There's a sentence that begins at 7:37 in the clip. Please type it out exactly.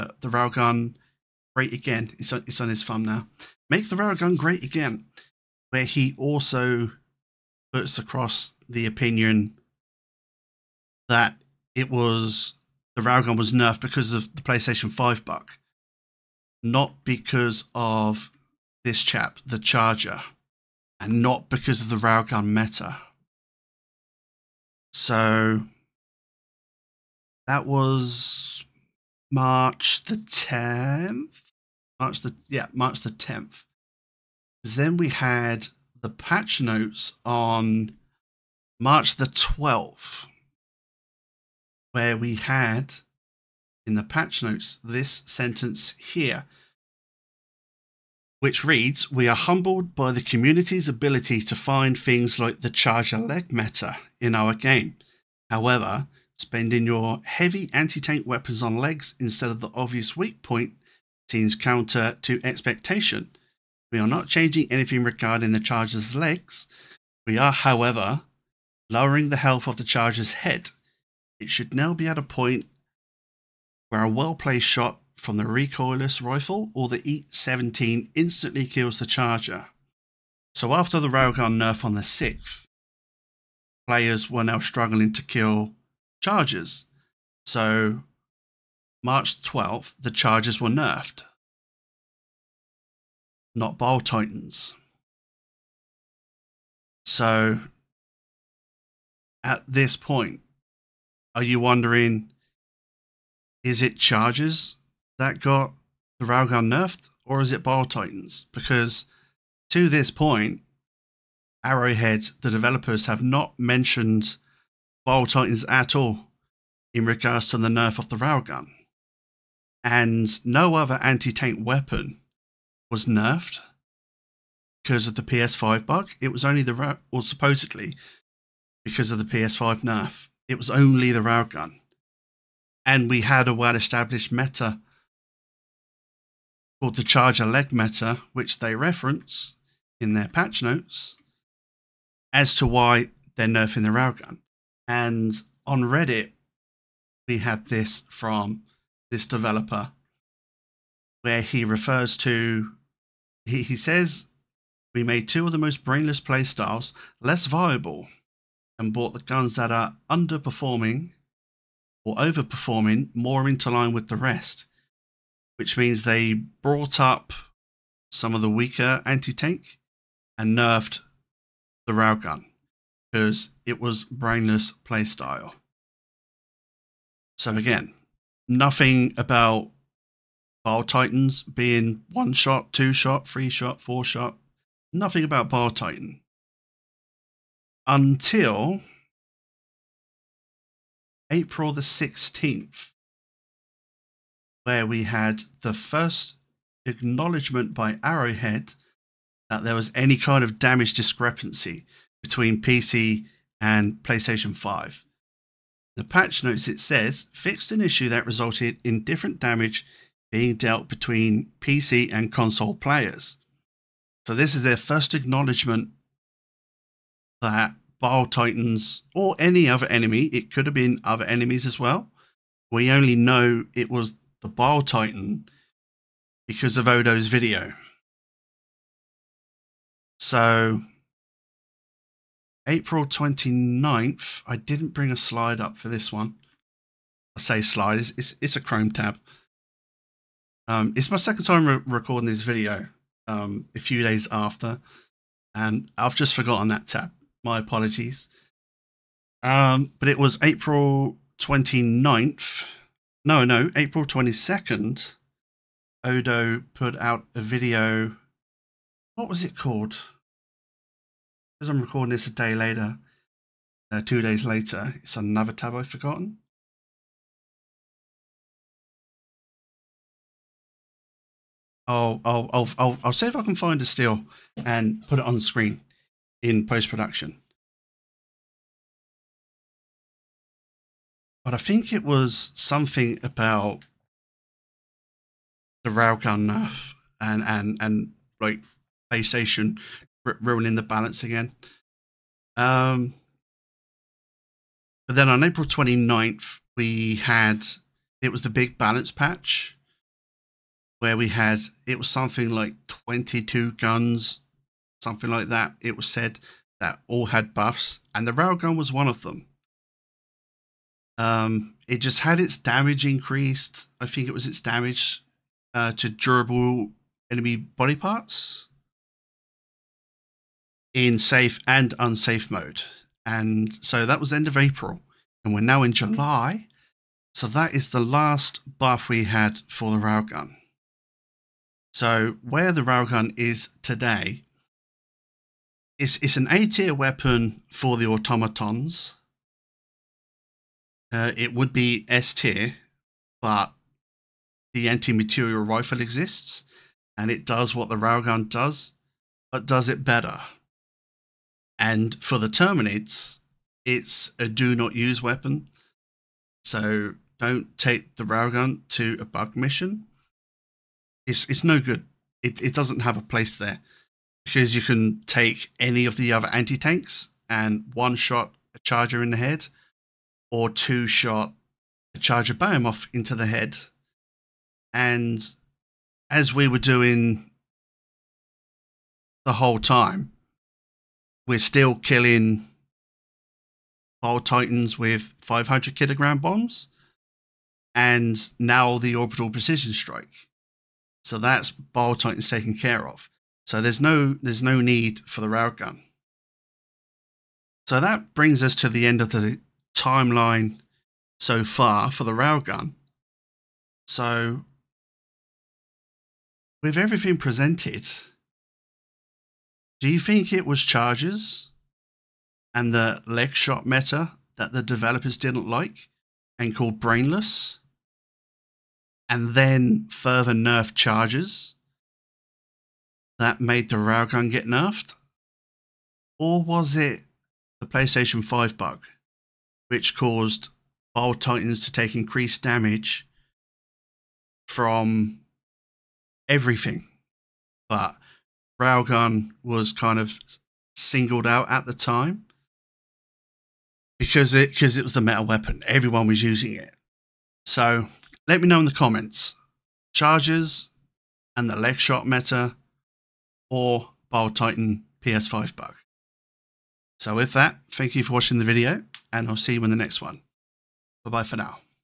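So with that, thank you for watching the video and I'll see you in the next one.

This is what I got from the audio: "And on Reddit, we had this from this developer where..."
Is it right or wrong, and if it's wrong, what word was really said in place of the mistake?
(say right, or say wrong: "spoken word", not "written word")
right.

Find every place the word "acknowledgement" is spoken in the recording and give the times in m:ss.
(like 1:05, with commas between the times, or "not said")
3:16, 3:35.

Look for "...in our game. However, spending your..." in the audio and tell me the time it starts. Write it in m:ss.
0:54.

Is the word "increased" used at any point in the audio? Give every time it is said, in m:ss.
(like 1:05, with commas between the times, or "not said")
5:13, 7:12.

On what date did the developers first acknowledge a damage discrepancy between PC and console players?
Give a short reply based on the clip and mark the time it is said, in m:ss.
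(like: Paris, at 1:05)
April 16th, at 3:11.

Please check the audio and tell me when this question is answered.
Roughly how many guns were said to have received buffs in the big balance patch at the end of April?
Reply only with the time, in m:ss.
5:02.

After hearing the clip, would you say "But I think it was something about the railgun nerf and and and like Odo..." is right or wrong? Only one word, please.
wrong.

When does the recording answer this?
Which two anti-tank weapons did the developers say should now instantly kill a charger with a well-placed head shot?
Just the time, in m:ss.
1:15.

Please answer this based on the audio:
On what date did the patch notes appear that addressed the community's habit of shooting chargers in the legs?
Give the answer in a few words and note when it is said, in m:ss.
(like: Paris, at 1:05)
March 12th, at 0:38.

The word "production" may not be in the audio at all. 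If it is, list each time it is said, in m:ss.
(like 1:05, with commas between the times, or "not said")
4:36.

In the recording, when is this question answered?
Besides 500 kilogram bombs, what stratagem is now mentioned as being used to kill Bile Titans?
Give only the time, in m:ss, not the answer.
6:29.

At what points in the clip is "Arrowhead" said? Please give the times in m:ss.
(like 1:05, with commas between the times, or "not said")
1:51, 3:18.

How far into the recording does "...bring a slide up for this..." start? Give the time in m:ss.
3:54.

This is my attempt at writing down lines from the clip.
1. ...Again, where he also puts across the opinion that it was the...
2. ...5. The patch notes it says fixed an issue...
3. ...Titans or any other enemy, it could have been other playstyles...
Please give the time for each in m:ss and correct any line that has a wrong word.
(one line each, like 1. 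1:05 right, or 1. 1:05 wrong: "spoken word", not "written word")
1. 0:04 right
2. 3:24 right
3. 3:38 wrong: "enemies", not "playstyles".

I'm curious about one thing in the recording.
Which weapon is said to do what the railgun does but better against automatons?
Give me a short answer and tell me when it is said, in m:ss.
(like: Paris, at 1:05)
Anti-material rifle, at 5:44.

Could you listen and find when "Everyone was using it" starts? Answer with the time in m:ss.
7:25.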